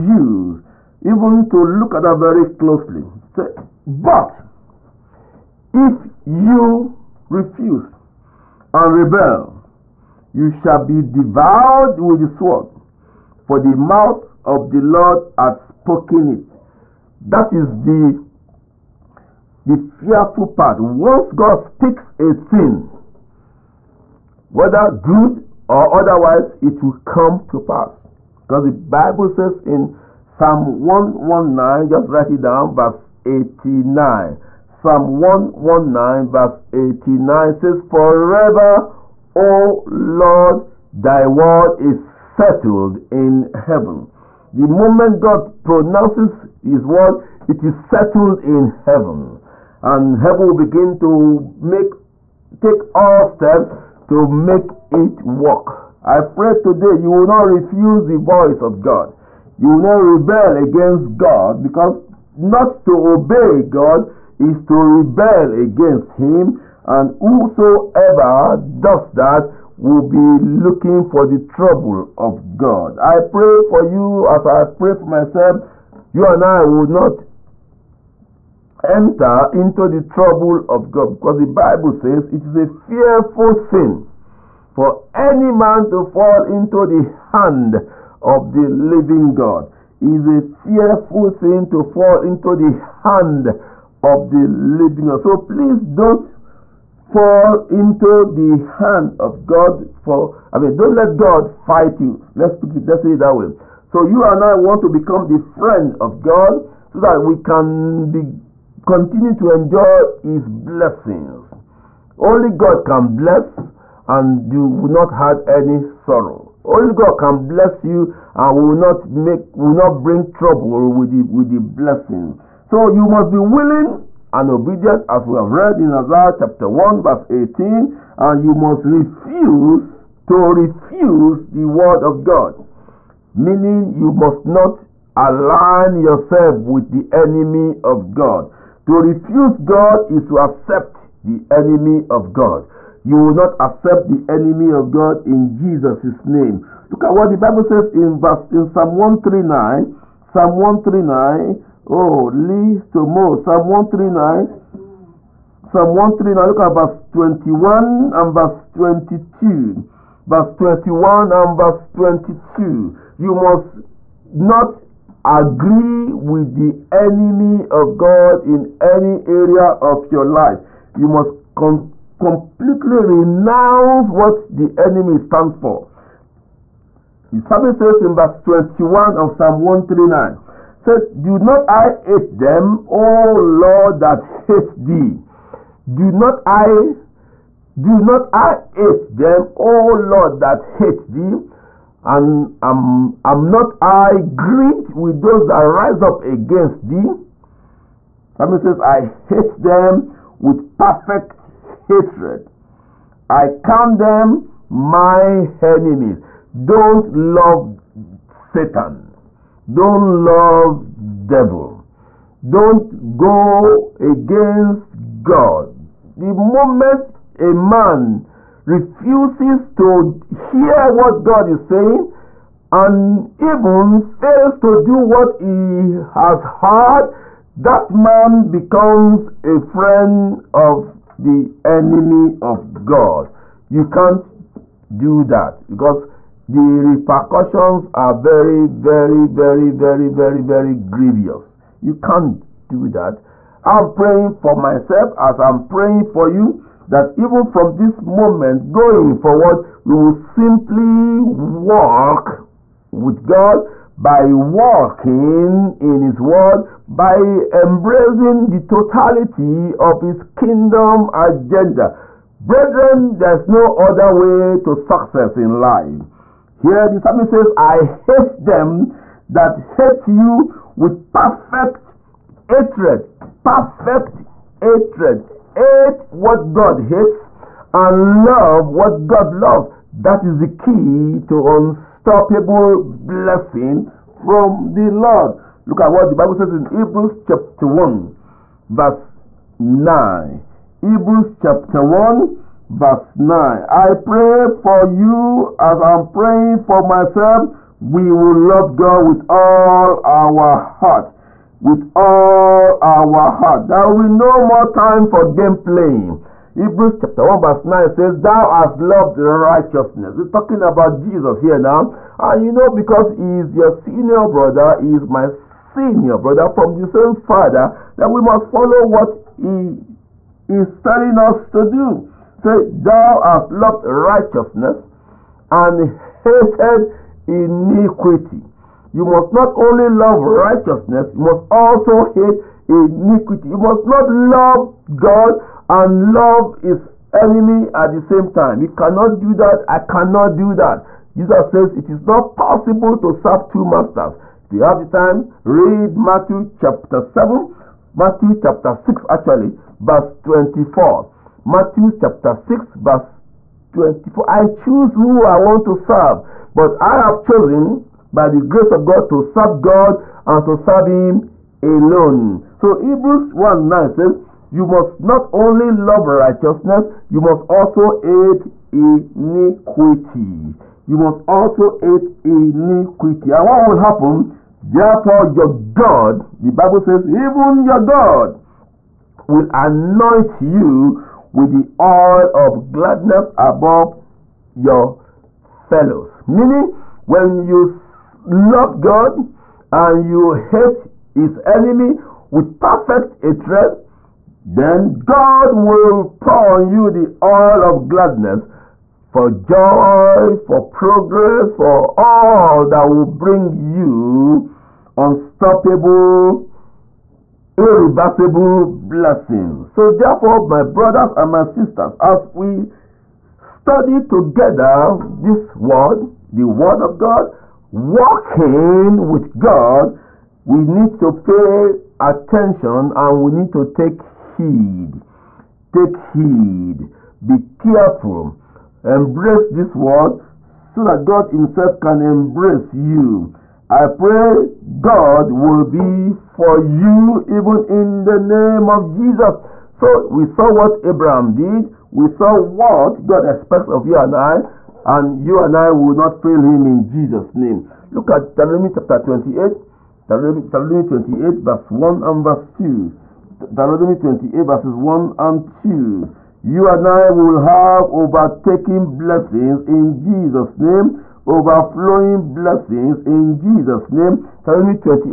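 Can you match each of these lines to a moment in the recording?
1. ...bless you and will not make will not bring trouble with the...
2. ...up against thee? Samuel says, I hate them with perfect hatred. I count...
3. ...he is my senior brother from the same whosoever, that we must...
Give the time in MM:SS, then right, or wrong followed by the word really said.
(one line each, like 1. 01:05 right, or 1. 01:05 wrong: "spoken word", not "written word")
1. 01:57 right
2. 03:16 right
3. 05:14 wrong: "father", not "whosoever".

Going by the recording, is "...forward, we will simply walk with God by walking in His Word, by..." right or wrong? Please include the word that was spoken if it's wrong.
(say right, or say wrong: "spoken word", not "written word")
right.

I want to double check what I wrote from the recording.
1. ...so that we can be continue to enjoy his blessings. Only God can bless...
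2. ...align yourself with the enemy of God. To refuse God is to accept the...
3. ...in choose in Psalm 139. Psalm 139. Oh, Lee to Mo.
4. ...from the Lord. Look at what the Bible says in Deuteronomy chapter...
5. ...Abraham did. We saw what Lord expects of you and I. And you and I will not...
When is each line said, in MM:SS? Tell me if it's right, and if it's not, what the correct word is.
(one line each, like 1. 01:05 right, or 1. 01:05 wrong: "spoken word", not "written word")
1. 01:46 right
2. 02:15 right
3. 02:27 wrong: "verse", not "choose"
4. 04:44 wrong: "Hebrews", not "Deuteronomy"
5. 07:20 wrong: "God", not "Lord".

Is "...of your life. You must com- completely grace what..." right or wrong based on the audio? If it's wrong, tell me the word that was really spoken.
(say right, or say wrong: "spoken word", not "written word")
wrong: "renounce", not "grace".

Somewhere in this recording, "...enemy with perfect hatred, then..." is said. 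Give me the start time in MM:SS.
06:31.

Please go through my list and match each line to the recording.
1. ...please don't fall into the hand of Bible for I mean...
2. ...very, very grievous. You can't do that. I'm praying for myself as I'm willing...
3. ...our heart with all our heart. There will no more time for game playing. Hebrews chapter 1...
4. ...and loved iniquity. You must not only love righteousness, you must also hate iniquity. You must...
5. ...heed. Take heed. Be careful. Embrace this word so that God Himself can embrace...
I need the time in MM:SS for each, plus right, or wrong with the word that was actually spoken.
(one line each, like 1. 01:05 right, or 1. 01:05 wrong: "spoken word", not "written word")
1. 01:35 wrong: "God", not "Bible"
2. 04:00 wrong: "praying", not "willing"
3. 05:00 right
4. 05:25 wrong: "hated", not "loved"
5. 07:04 right.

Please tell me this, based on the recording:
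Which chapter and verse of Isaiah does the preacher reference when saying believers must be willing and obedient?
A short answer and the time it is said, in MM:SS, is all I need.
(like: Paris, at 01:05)
Isaiah 1:18, at 02:05.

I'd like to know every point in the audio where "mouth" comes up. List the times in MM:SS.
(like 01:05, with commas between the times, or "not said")
00:13.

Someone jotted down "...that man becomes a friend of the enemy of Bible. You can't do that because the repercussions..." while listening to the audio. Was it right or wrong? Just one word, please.
wrong.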